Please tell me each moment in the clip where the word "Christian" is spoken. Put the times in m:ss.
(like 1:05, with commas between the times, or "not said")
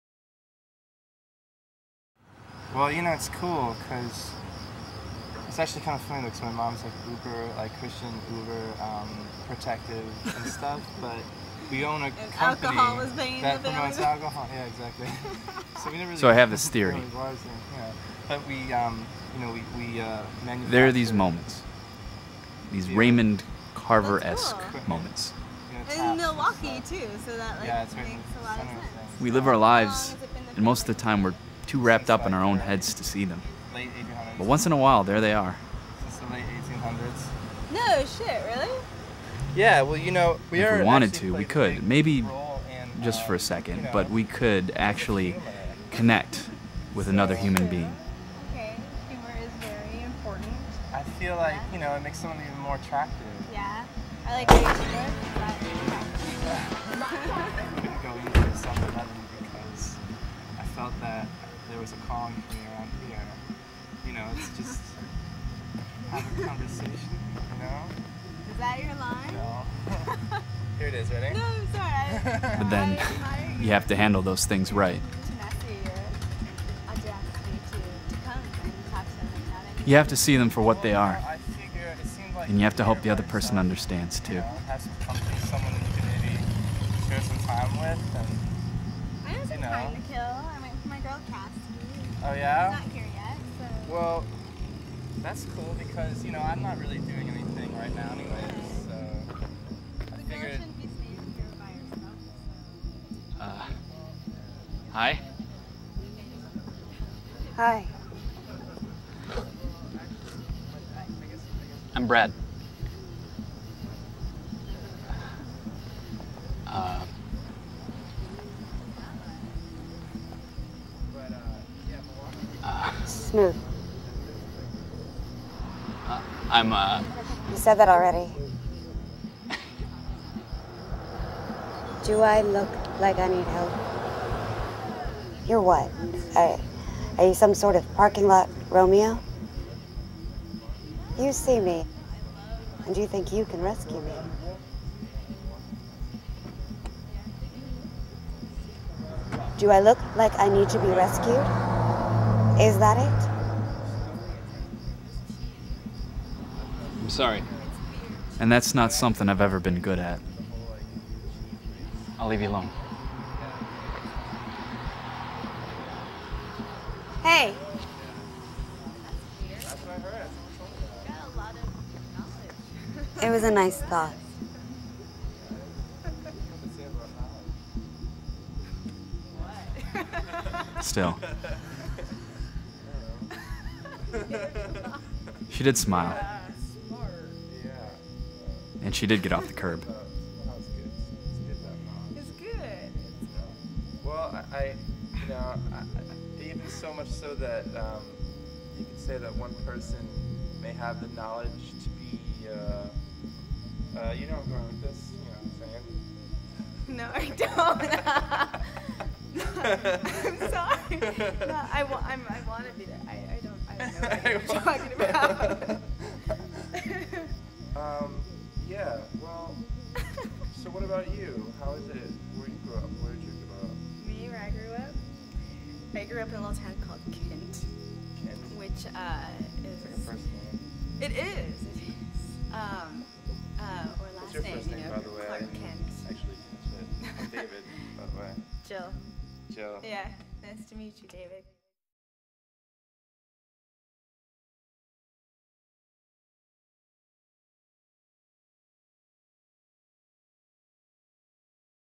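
0:07.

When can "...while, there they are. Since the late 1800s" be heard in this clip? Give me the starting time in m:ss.
0:34.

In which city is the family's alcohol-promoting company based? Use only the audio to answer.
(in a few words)
Milwaukee.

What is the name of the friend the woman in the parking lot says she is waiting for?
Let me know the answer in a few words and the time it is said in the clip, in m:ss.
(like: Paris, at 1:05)
Cassidy, at 1:31.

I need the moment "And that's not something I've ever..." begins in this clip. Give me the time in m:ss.
2:38.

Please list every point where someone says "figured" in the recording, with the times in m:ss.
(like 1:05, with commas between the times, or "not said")
1:40.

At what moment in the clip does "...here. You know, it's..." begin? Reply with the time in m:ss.
1:03.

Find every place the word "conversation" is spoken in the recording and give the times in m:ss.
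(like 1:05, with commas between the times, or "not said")
1:06.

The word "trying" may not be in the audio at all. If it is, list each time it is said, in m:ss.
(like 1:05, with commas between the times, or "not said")
1:29.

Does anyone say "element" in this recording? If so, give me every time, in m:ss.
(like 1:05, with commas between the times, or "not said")
not said.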